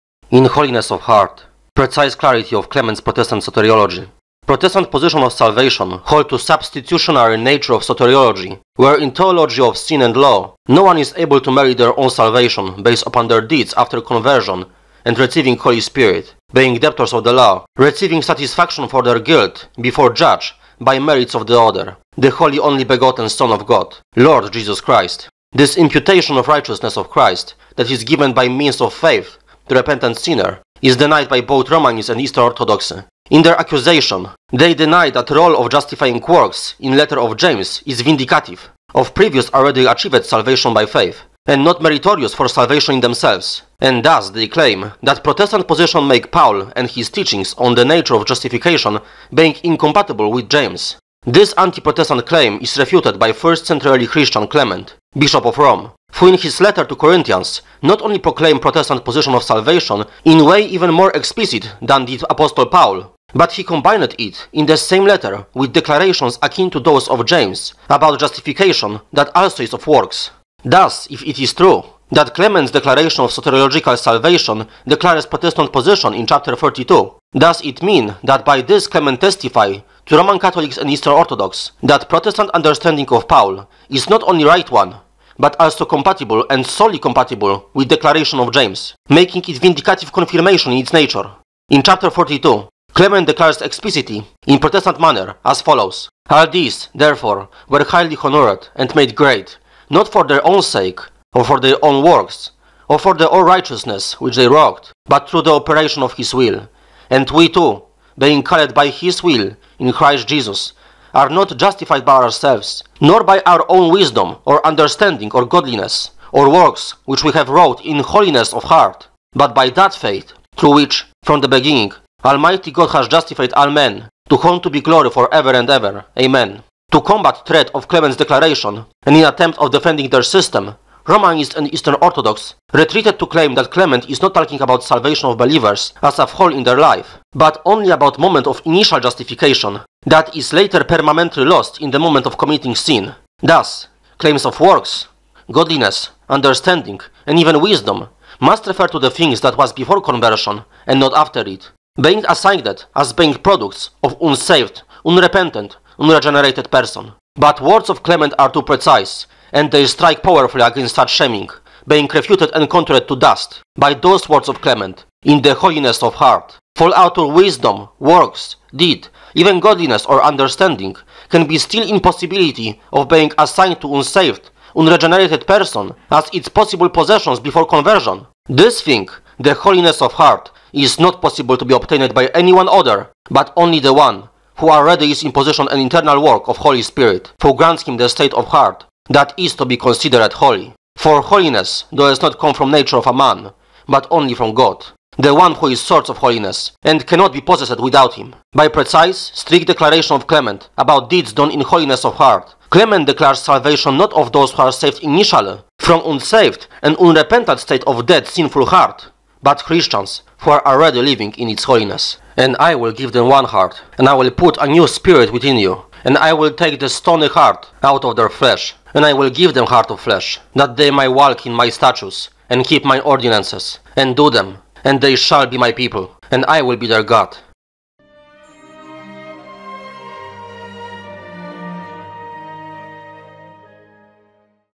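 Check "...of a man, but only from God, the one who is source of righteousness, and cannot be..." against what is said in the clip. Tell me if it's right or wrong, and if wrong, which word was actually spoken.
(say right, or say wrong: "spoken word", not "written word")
wrong: "holiness", not "righteousness".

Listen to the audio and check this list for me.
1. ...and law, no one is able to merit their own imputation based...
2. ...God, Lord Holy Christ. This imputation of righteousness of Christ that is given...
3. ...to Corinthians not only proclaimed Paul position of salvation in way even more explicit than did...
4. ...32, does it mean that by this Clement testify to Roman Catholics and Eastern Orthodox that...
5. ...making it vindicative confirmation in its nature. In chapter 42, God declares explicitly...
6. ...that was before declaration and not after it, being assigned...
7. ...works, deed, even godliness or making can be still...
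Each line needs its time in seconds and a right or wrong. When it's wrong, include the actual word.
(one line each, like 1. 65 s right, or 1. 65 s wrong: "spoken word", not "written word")
1. 10 s wrong: "salvation", not "imputation"
2. 23 s wrong: "Jesus", not "Holy"
3. 56 s wrong: "Protestant", not "Paul"
4. 76 s right
5. 89 s wrong: "Clement", not "God"
6. 149 s wrong: "conversion", not "declaration"
7. 167 s wrong: "understanding", not "making".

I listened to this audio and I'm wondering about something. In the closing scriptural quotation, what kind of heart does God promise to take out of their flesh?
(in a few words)
stony heart.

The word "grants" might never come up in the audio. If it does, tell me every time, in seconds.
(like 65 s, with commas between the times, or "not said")
187 s.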